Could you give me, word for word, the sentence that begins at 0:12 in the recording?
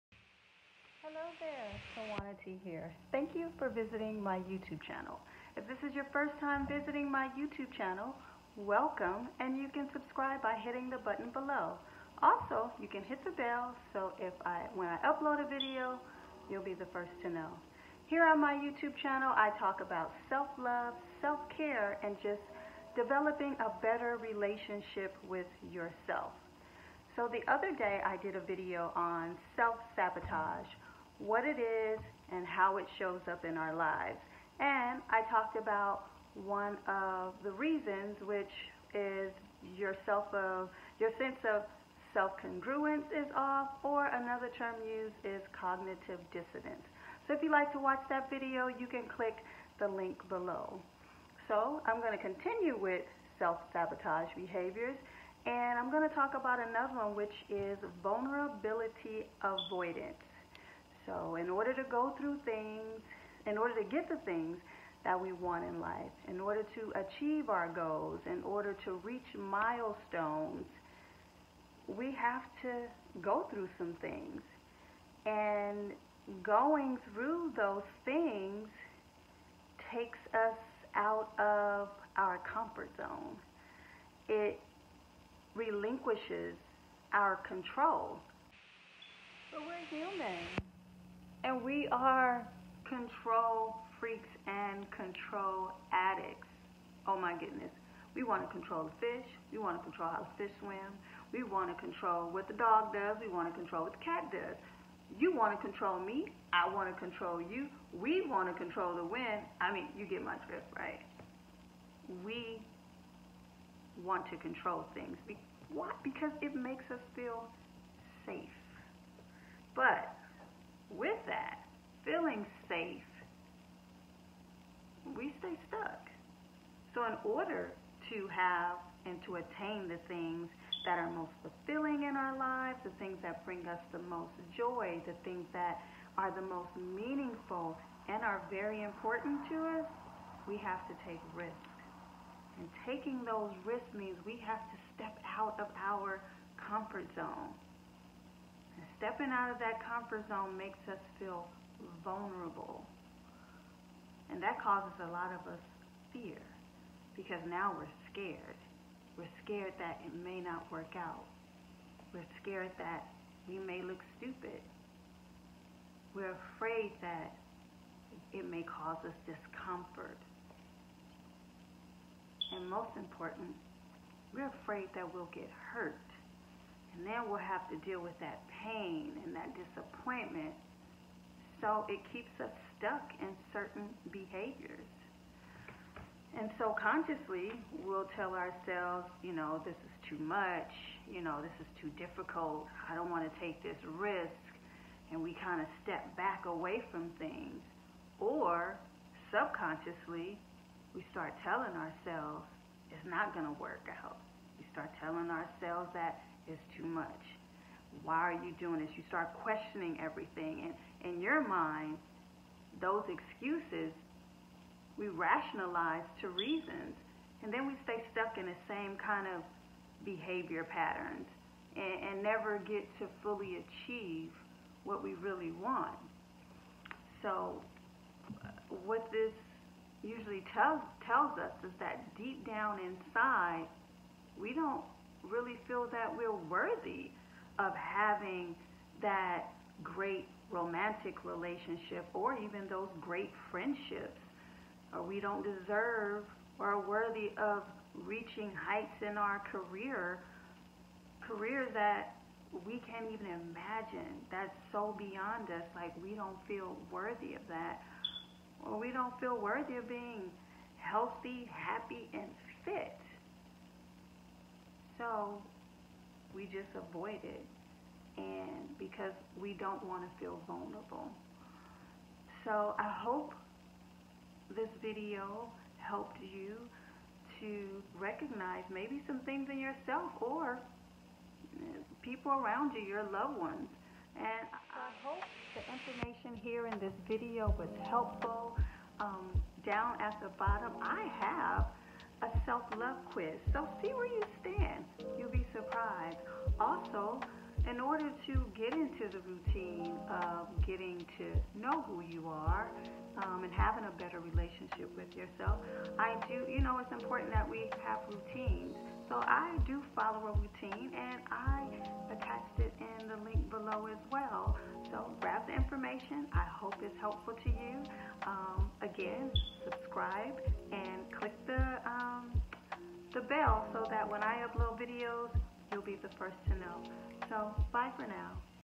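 Also, you can hit the bell so if I when I upload a video, you'll be the first to know.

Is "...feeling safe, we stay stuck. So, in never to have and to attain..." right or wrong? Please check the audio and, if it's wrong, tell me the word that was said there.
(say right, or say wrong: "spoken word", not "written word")
wrong: "order", not "never".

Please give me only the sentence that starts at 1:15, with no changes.
And going through those things takes us out of our comfort zone.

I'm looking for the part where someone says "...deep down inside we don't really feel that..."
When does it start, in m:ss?
3:52.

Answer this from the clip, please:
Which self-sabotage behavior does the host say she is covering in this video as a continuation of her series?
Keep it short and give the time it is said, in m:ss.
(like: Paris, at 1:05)
vulnerability avoidance, at 0:58.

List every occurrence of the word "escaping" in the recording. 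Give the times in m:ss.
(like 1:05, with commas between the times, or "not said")
not said.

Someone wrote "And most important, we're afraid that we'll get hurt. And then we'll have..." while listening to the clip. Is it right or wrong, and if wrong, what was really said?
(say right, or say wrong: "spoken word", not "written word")
right.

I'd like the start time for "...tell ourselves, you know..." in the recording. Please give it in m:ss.
3:08.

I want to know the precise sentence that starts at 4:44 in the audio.
And I hope the information here in this video was helpful.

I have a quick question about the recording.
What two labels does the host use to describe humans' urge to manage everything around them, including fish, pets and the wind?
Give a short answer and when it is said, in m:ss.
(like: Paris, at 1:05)
control freaks and control addicts, at 1:32.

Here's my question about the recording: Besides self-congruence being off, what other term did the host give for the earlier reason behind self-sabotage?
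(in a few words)
cognitive dissonance.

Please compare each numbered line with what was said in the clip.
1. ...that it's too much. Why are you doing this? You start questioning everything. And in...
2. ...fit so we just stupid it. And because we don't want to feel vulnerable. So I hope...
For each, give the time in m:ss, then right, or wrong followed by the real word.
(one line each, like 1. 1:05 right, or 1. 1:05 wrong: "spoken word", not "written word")
1. 3:25 right
2. 4:22 wrong: "avoid", not "stupid".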